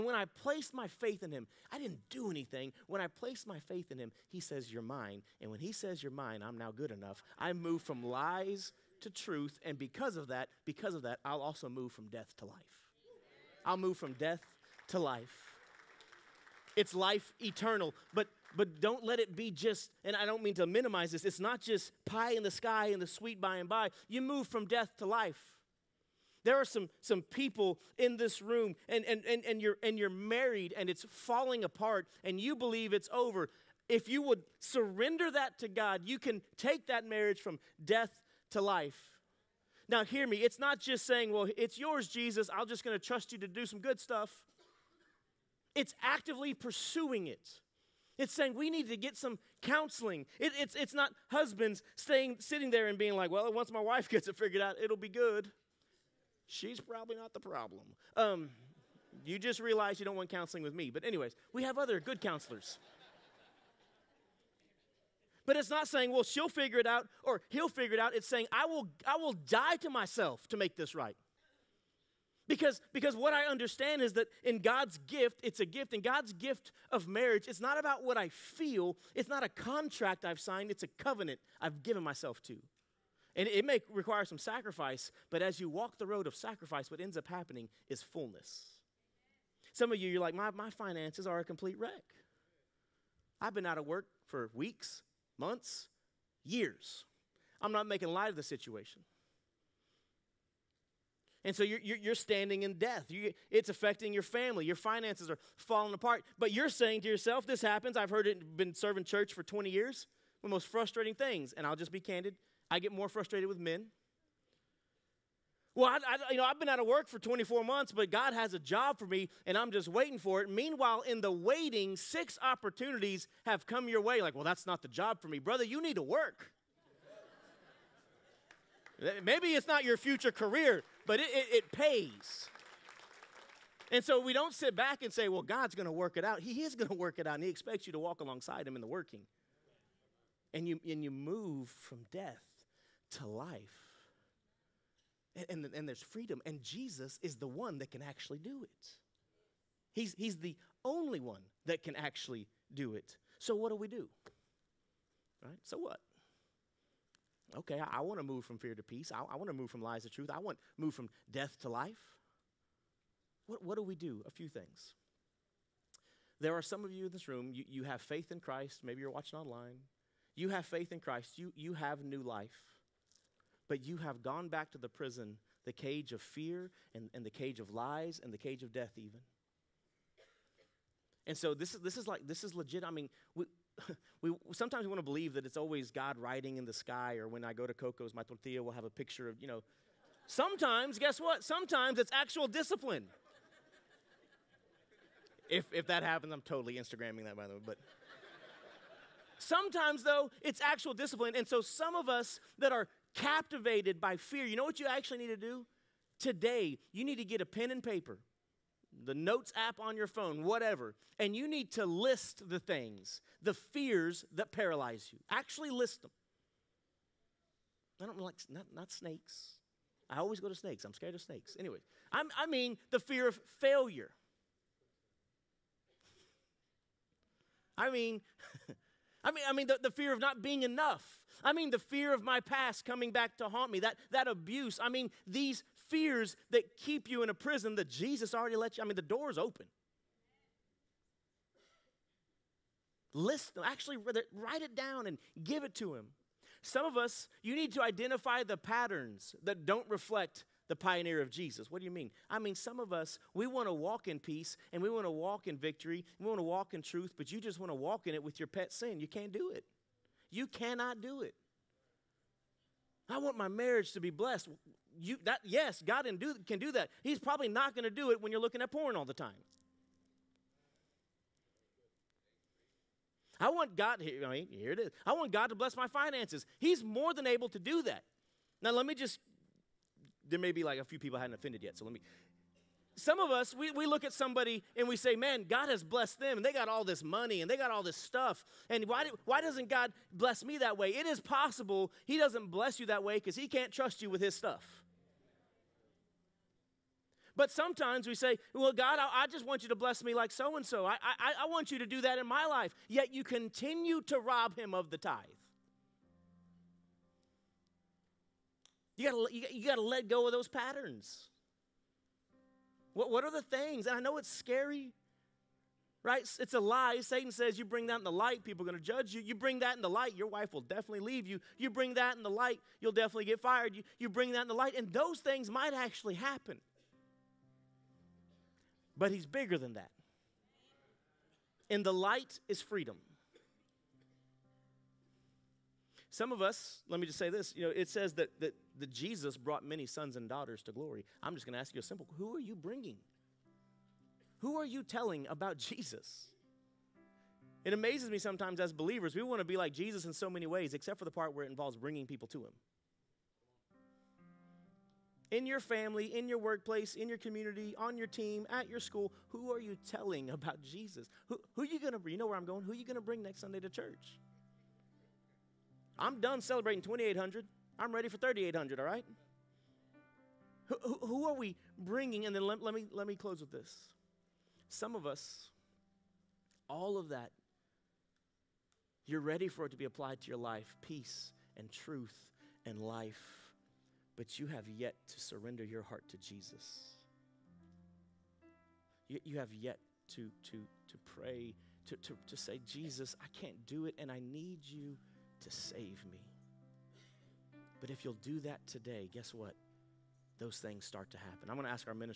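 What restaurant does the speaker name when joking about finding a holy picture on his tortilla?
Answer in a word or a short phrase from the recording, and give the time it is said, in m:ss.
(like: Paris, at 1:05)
Coco's, at 3:07.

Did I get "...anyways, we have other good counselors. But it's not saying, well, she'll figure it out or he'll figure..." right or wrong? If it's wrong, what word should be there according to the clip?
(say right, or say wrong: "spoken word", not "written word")
right.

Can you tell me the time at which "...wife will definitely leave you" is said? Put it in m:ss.
5:20.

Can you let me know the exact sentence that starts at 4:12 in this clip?
I mean, some of us, we want to walk in peace and we want to walk in victory.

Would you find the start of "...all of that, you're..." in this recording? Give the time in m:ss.
6:16.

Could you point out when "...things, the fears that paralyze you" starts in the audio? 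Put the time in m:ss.
3:32.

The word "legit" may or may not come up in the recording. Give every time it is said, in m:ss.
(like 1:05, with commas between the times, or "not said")
3:02.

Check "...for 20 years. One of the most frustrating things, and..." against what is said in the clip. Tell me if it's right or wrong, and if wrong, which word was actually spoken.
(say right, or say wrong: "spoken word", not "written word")
right.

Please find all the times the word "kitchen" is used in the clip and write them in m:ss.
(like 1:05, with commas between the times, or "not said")
not said.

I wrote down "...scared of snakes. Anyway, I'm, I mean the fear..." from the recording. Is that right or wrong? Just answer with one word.
right.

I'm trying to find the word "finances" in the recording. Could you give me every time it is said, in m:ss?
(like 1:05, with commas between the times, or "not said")
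1:30, 1:44, 4:35.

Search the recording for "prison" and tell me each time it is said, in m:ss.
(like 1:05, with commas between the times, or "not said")
2:54, 3:57.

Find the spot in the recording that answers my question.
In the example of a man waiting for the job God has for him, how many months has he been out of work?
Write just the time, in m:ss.
1:57.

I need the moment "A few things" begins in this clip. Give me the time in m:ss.
2:44.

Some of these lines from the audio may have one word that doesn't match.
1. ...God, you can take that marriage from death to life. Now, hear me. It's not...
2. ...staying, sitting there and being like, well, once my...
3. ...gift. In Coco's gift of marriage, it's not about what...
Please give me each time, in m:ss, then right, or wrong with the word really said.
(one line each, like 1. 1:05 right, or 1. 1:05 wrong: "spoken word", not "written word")
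1. 0:35 right
2. 0:51 right
3. 1:15 wrong: "God", not "Coco".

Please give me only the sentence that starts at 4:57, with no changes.
But sometimes we say, Well, God, I, I, just want you to bless me like so and so.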